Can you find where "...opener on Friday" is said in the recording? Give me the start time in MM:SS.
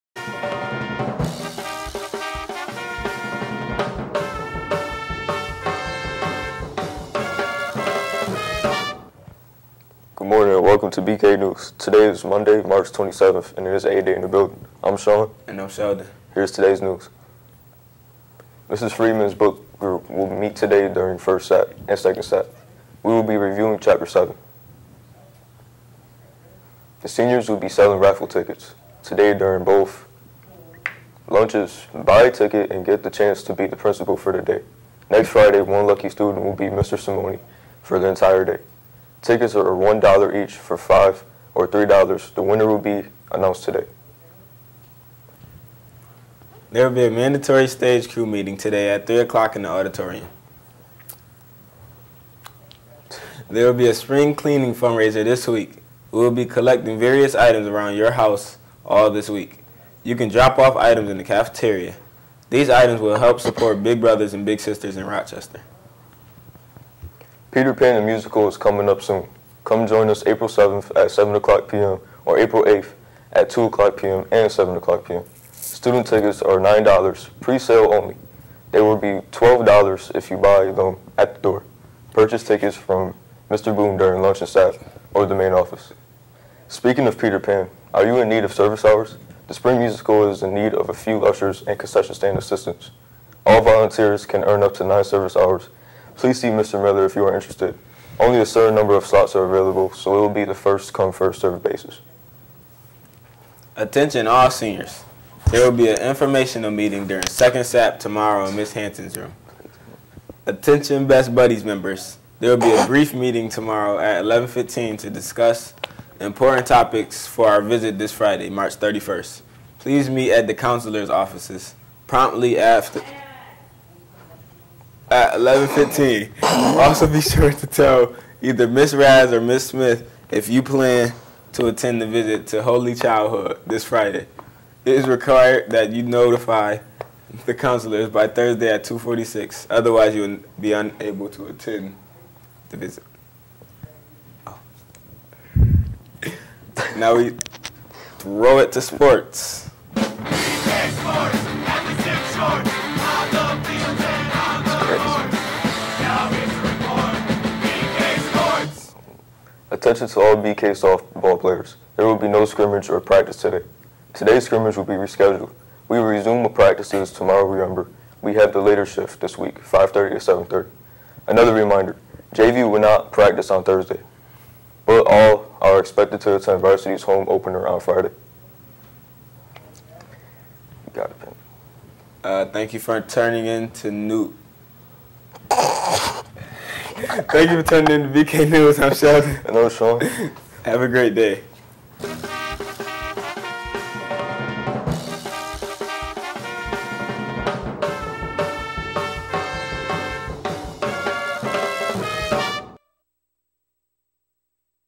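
02:57.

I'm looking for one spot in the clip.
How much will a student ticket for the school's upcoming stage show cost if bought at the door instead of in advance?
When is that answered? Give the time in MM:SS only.
01:19.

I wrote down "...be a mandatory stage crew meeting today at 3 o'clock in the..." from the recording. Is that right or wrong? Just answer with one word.
right.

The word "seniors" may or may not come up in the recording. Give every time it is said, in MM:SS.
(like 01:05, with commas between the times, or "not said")
00:27, 01:44.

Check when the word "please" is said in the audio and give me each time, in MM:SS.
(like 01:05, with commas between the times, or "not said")
01:36, 01:59.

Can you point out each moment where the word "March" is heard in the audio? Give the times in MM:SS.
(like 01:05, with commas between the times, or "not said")
00:12, 01:58.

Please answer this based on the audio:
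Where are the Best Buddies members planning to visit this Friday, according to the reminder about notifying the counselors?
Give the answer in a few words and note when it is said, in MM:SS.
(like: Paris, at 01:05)
Holy Childhood, at 02:12.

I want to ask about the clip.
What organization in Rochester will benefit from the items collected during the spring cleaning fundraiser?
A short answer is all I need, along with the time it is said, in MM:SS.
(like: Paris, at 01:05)
Big Brothers and Big Sisters, at 01:03.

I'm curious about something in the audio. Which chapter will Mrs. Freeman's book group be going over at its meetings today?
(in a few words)
Chapter 7.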